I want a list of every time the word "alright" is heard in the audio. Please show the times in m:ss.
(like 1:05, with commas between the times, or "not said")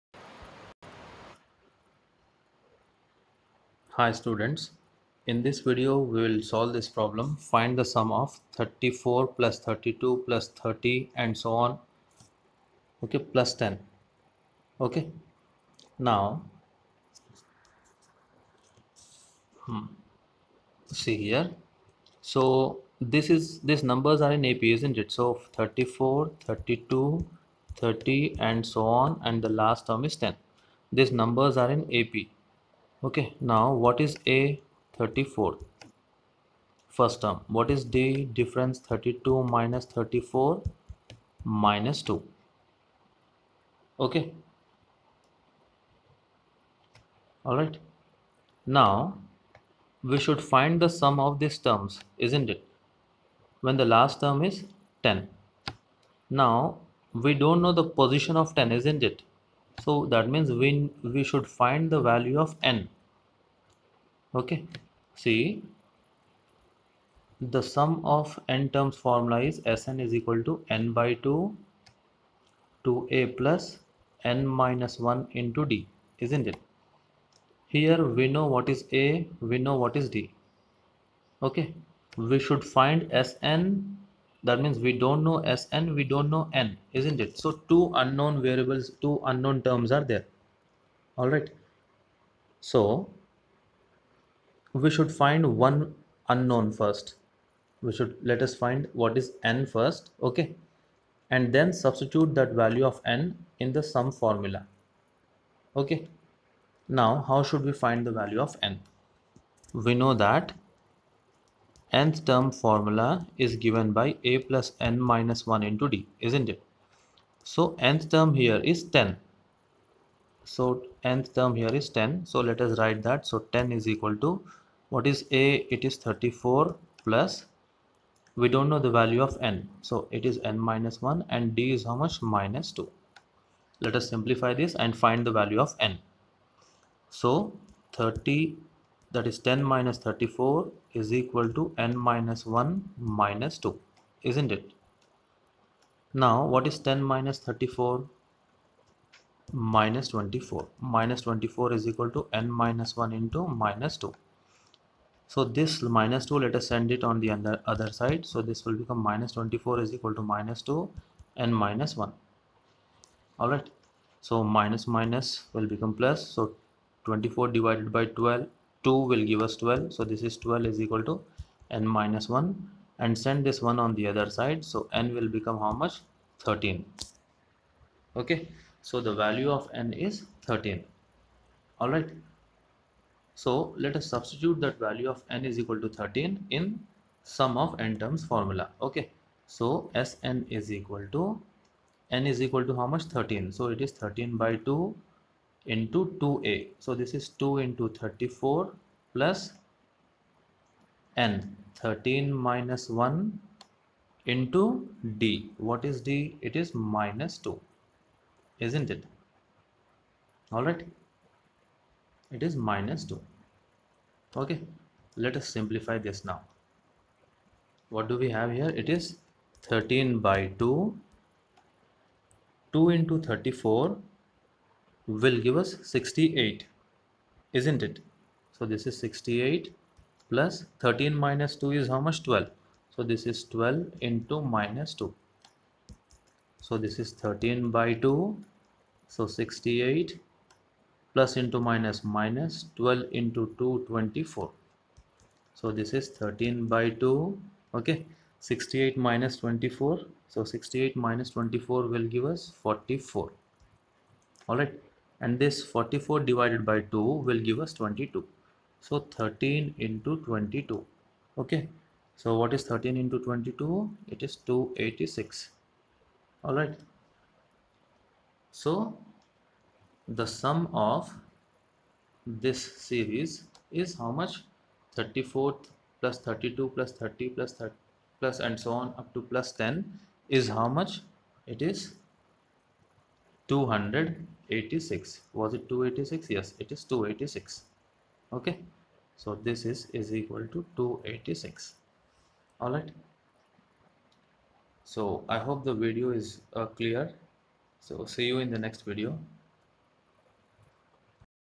2:43, 3:30.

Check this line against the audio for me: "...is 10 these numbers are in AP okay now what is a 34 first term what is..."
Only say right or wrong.
right.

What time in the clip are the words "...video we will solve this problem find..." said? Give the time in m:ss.
0:05.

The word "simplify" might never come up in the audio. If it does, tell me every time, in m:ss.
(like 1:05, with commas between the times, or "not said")
2:14, 3:35.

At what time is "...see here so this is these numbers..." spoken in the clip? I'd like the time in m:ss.
0:21.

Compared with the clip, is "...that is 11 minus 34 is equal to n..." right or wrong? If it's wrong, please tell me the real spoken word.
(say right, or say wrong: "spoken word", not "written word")
wrong: "10", not "11".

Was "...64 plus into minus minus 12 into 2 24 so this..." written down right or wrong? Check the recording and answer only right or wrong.
wrong.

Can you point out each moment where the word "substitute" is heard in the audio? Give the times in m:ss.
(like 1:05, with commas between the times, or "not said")
1:41, 3:04.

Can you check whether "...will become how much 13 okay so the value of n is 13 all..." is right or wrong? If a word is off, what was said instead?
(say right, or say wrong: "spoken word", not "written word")
right.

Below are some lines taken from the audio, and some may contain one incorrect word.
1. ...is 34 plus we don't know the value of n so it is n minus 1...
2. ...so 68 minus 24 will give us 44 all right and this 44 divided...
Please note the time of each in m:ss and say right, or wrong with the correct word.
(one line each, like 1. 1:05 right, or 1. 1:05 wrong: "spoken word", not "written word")
1. 2:05 right
2. 4:10 right.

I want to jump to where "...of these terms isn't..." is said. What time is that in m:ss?
0:51.